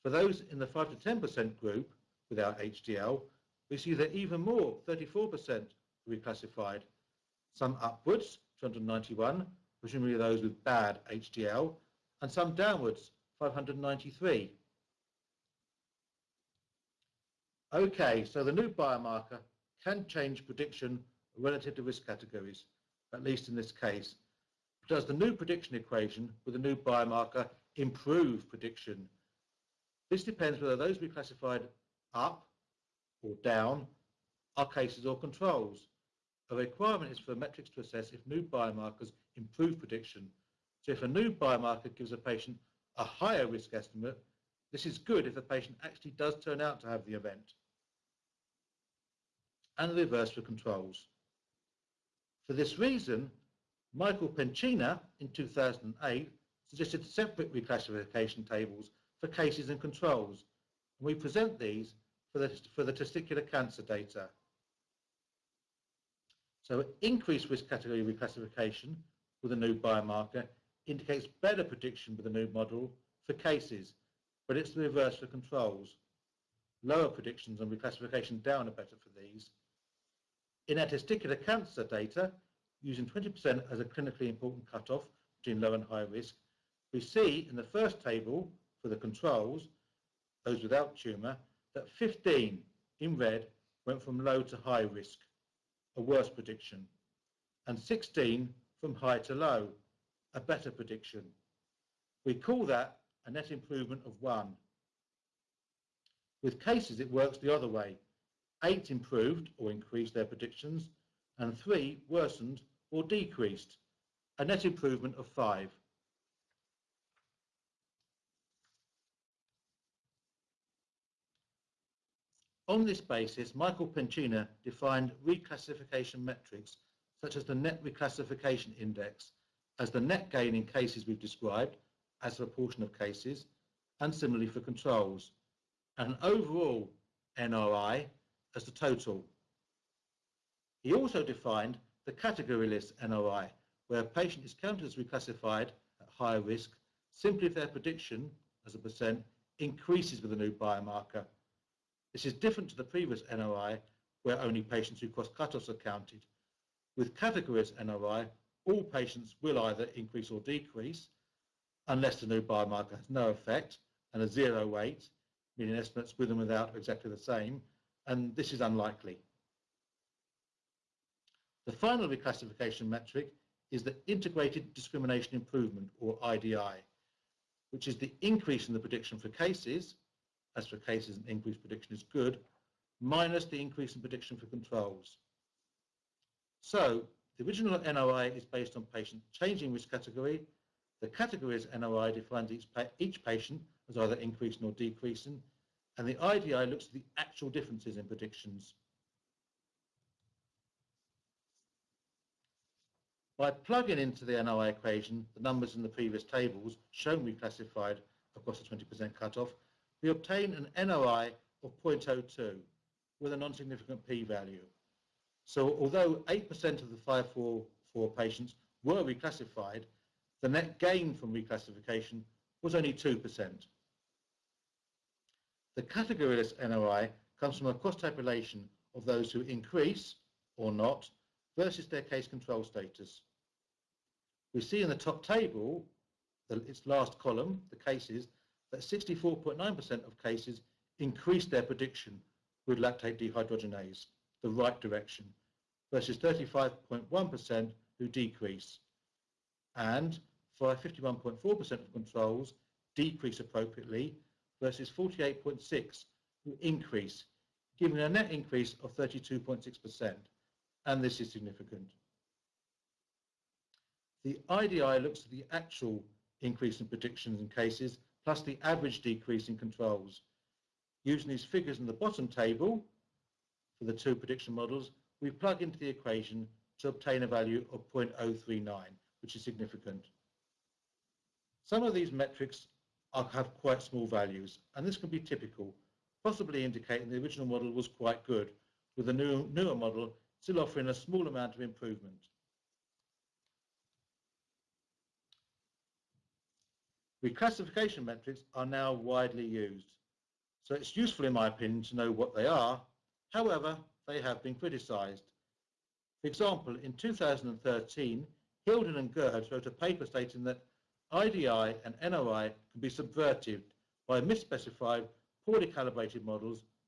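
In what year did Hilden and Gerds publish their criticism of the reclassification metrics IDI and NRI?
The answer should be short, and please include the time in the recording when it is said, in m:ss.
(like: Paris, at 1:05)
2013, at 5:06.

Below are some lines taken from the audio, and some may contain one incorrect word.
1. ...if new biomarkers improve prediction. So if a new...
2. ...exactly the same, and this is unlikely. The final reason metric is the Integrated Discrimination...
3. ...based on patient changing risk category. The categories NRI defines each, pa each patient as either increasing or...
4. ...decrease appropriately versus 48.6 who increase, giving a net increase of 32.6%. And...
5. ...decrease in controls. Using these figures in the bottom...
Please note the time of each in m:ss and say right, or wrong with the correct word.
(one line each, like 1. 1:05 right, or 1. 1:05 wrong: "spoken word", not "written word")
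1. 0:38 right
2. 2:46 wrong: "reclassification", not "reason"
3. 3:08 right
4. 4:12 right
5. 4:28 right.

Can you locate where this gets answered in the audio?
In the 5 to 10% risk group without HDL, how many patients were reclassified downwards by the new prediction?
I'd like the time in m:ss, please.
0:13.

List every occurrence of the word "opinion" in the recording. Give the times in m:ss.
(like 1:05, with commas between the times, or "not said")
5:01.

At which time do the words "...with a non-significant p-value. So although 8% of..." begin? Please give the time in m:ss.
3:33.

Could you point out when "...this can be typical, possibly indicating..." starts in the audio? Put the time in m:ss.
4:44.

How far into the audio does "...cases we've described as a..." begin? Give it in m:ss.
2:10.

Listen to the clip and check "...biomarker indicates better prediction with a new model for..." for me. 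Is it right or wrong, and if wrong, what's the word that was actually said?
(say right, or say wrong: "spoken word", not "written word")
right.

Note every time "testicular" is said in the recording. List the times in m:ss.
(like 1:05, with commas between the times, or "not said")
1:02, 1:20.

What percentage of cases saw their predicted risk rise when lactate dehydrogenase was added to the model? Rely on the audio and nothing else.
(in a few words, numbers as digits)
64.9%.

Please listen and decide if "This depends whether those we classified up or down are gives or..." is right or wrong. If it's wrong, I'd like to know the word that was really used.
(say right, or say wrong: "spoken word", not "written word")
wrong: "cases", not "gives".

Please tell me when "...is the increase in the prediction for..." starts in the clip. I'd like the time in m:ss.
2:57.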